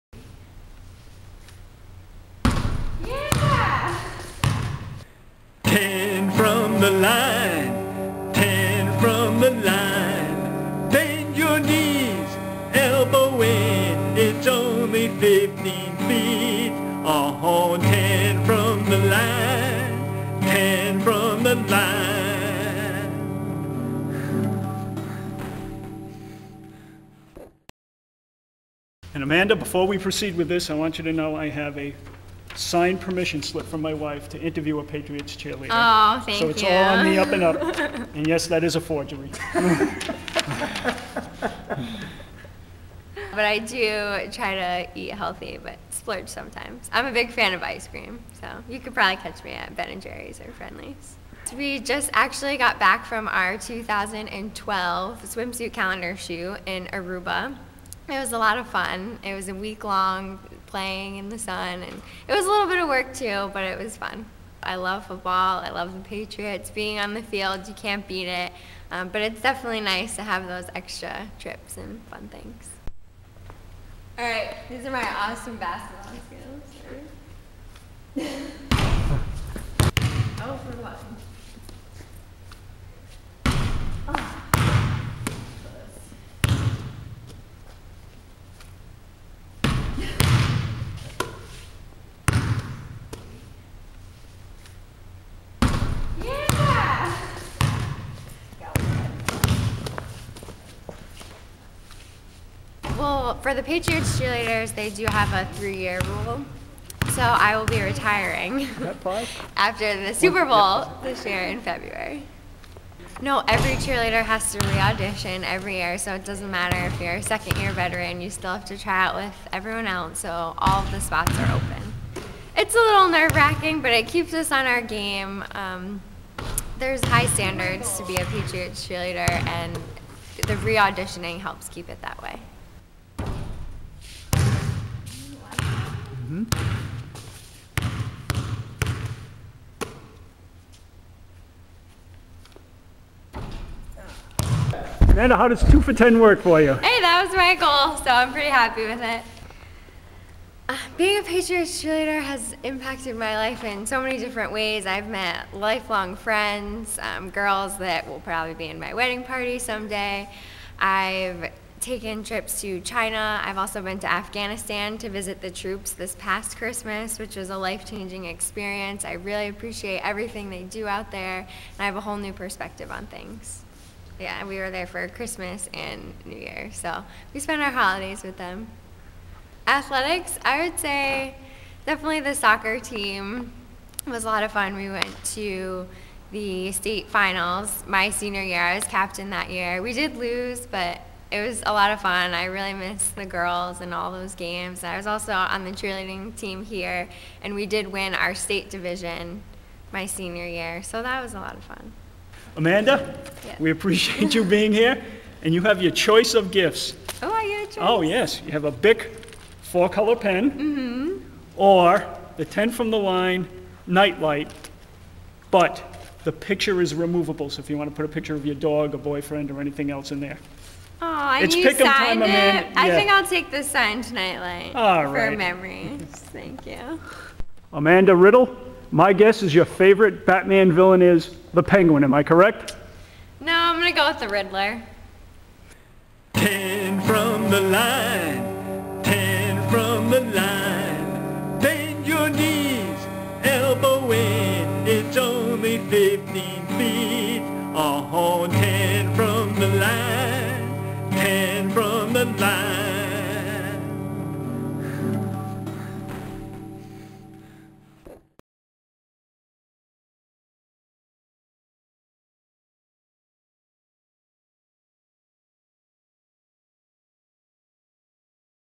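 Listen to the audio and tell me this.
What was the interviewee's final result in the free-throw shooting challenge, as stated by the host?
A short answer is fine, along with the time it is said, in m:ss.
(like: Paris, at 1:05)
2 for 10, at 2:25.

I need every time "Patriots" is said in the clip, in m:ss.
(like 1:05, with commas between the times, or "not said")
0:34, 1:05, 1:43, 2:08, 2:31.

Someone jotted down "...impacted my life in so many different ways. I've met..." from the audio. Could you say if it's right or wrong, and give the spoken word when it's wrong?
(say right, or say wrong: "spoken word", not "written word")
right.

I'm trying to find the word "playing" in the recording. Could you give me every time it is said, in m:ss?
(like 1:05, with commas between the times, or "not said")
1:00.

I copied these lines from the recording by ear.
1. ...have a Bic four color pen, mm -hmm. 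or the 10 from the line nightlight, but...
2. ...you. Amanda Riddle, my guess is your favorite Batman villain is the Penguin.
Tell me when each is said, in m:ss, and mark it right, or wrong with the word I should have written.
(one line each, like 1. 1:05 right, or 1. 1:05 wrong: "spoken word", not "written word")
1. 3:28 right
2. 3:46 right.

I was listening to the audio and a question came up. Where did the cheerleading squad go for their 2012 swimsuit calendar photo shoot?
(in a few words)
Aruba.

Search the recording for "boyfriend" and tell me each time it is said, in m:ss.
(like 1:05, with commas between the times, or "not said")
3:38.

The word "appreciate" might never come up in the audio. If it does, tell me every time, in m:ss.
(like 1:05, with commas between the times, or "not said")
2:49, 3:23.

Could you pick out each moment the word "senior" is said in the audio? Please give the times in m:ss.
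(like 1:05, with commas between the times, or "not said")
3:08, 3:20.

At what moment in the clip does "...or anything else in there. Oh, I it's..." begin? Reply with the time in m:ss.
3:39.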